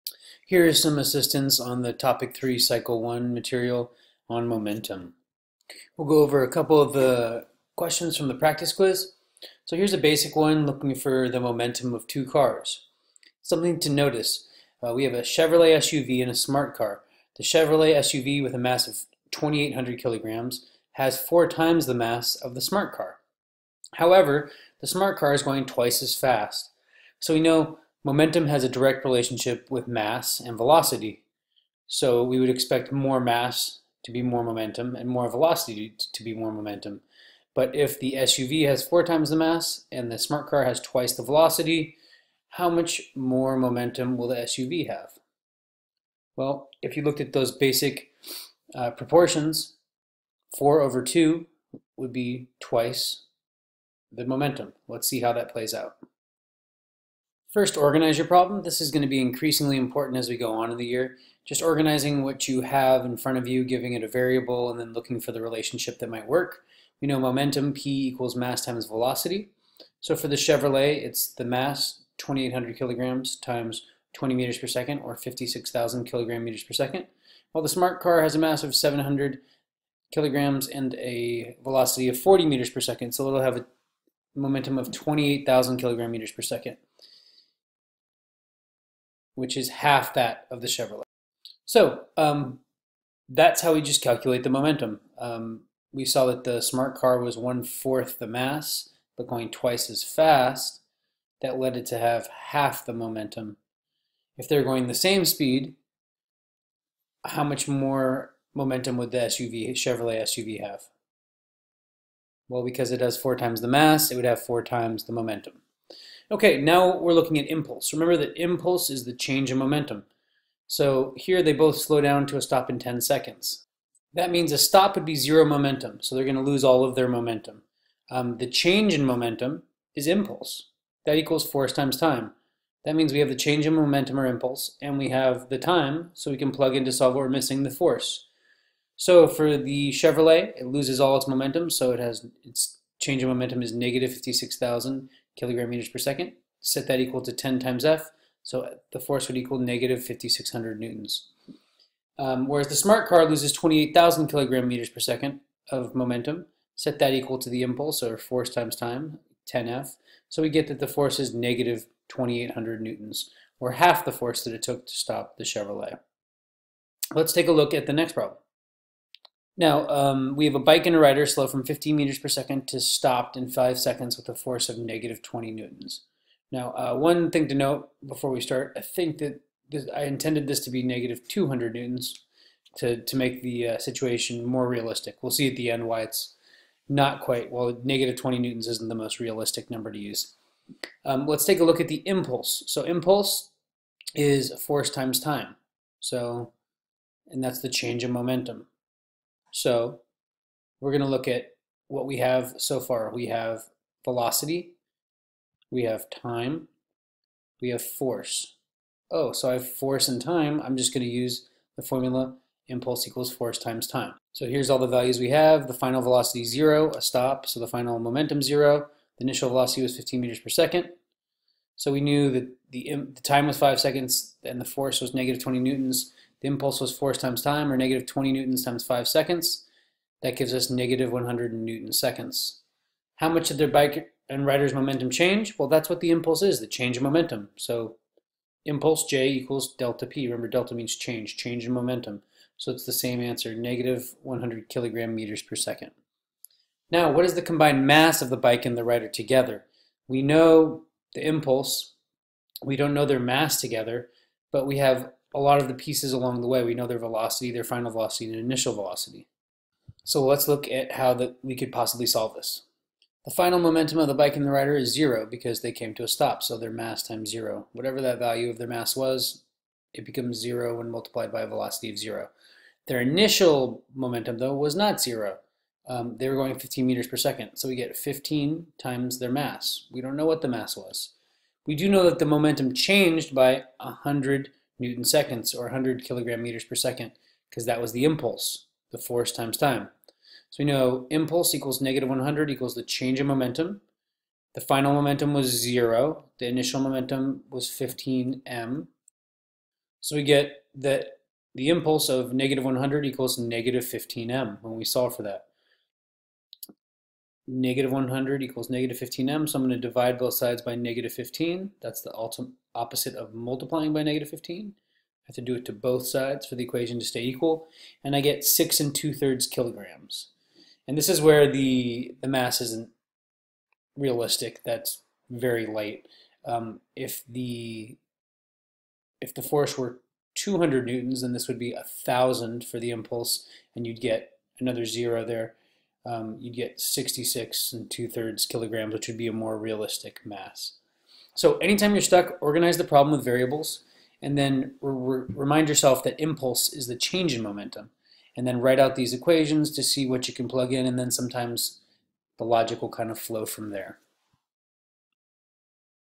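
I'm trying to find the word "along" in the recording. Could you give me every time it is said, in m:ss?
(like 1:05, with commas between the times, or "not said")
4:16.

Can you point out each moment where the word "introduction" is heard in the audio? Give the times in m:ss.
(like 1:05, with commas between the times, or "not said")
not said.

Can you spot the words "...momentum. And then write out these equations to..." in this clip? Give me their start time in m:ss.
5:47.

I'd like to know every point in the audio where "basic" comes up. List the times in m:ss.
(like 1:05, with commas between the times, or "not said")
0:09, 0:47.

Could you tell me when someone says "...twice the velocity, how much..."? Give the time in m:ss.
0:40.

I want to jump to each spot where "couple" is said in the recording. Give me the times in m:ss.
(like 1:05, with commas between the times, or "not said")
0:06.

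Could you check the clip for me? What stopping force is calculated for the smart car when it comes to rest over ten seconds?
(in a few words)
-2,800 N.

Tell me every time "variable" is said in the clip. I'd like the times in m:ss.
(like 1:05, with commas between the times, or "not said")
1:04, 5:43.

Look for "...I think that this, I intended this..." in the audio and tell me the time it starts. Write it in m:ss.
2:58.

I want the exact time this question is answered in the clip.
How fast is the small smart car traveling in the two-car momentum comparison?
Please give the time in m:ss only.
1:22.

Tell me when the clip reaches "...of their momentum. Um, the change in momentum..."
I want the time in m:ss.
2:06.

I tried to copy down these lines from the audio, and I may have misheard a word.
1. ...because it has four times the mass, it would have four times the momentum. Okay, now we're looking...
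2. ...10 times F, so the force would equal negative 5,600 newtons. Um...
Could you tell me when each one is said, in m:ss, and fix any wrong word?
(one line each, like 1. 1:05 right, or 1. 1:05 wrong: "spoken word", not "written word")
1. 1:52 right
2. 2:27 right.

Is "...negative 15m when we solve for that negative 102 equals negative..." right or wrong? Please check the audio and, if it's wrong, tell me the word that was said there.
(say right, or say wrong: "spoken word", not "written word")
wrong: "100", not "102".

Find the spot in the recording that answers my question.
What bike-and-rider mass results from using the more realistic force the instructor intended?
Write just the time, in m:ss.
5:36.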